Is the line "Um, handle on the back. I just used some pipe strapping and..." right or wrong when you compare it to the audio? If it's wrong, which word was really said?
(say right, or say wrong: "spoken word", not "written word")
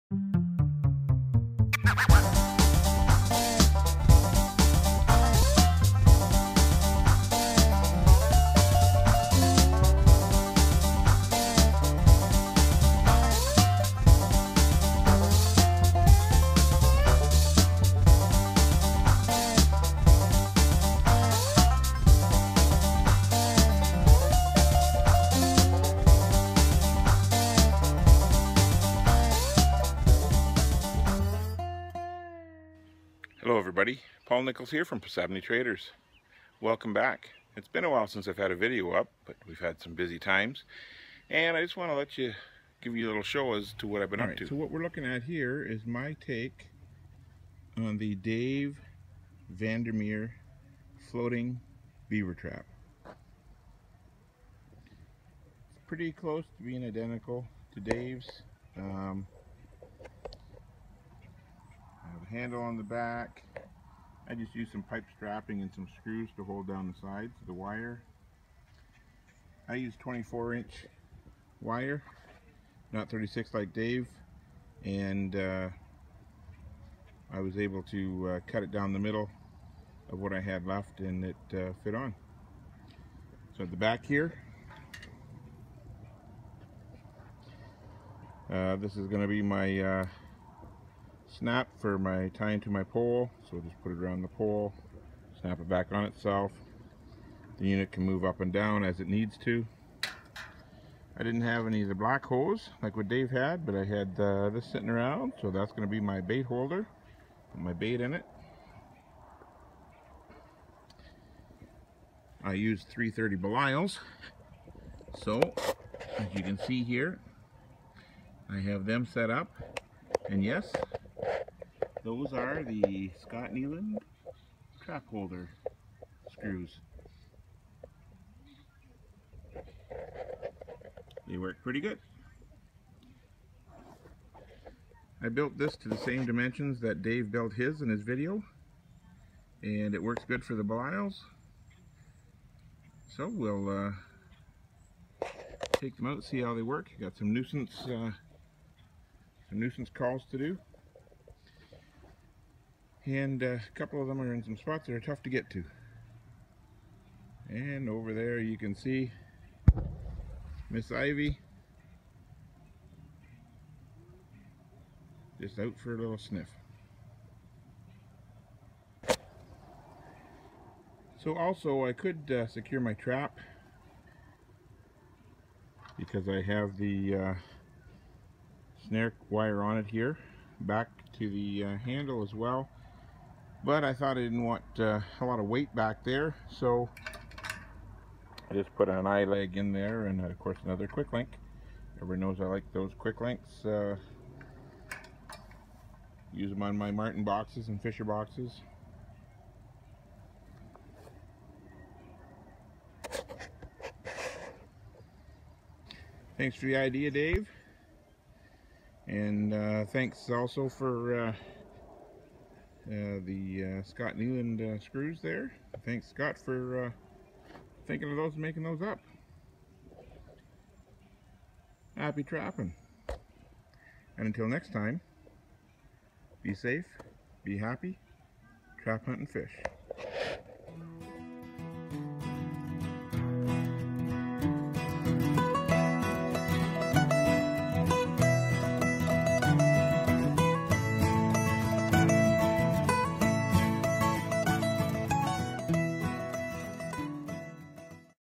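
right.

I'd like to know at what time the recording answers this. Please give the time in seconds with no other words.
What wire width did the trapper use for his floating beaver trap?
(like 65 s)
69 s.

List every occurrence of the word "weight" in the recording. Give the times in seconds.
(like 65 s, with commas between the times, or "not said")
185 s.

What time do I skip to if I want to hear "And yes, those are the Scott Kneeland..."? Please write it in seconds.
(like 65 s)
120 s.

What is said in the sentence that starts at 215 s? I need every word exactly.
Thanks Scott for thinking of those and making those up.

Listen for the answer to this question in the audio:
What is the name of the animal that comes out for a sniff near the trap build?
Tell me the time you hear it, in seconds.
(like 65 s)
160 s.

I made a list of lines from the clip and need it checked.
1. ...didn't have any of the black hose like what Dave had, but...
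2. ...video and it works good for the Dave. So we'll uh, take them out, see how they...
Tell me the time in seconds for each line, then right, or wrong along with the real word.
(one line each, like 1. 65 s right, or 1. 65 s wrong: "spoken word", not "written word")
1. 101 s right
2. 138 s wrong: "Belisles", not "Dave".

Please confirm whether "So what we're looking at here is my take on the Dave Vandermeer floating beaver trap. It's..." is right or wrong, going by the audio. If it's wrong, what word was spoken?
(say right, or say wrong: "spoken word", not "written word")
right.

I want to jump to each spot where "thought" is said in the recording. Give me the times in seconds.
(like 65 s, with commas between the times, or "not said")
183 s.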